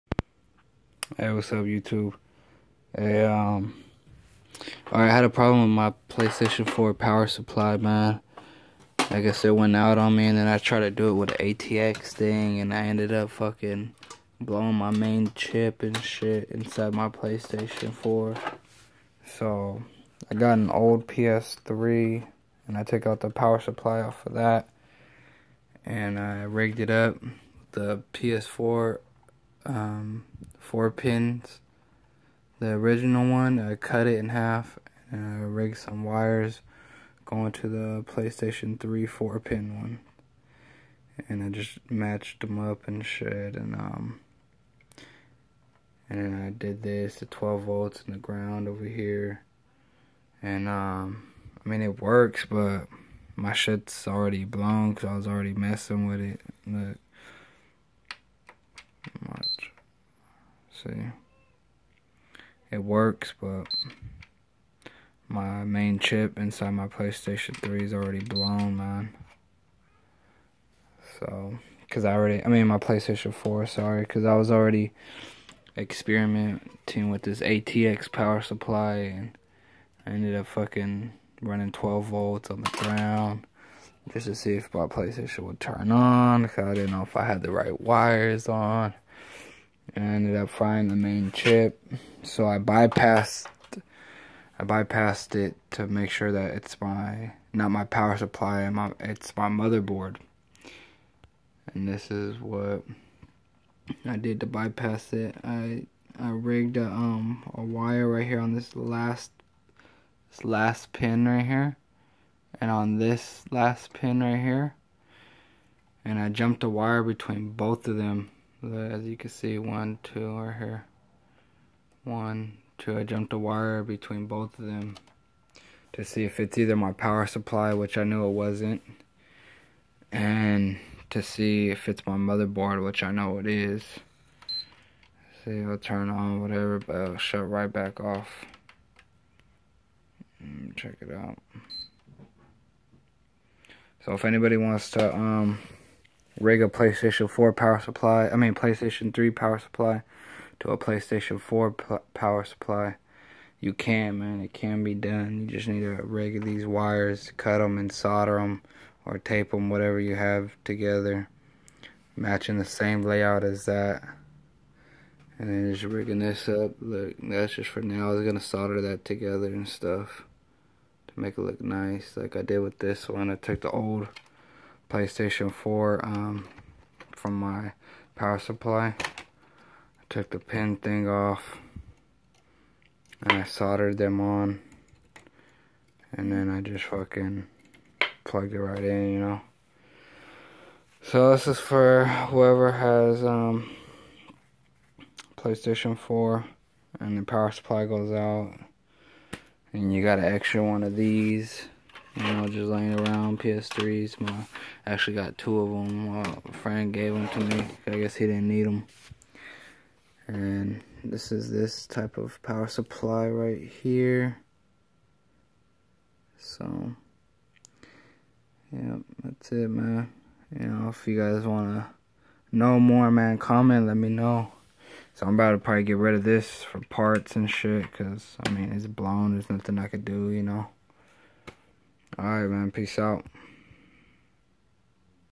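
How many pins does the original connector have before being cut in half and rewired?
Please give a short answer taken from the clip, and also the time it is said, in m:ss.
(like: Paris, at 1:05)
4, at 0:30.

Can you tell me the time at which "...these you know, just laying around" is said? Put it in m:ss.
3:20.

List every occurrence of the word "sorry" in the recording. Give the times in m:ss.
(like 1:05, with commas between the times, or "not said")
1:13.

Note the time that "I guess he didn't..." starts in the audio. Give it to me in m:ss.
3:27.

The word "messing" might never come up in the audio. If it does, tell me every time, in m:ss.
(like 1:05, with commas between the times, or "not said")
0:55.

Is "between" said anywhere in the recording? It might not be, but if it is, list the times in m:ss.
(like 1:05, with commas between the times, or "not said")
1:57, 2:03.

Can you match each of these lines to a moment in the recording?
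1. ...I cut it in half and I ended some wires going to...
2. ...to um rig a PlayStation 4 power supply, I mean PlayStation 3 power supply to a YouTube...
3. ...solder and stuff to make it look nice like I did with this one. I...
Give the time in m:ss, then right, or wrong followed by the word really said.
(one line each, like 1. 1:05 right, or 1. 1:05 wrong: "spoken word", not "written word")
1. 0:33 wrong: "rigged", not "ended"
2. 2:24 wrong: "PlayStation", not "YouTube"
3. 2:49 wrong: "together", not "solder".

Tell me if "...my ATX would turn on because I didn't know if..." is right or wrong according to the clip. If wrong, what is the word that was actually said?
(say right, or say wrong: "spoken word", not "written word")
wrong: "PlayStation", not "ATX".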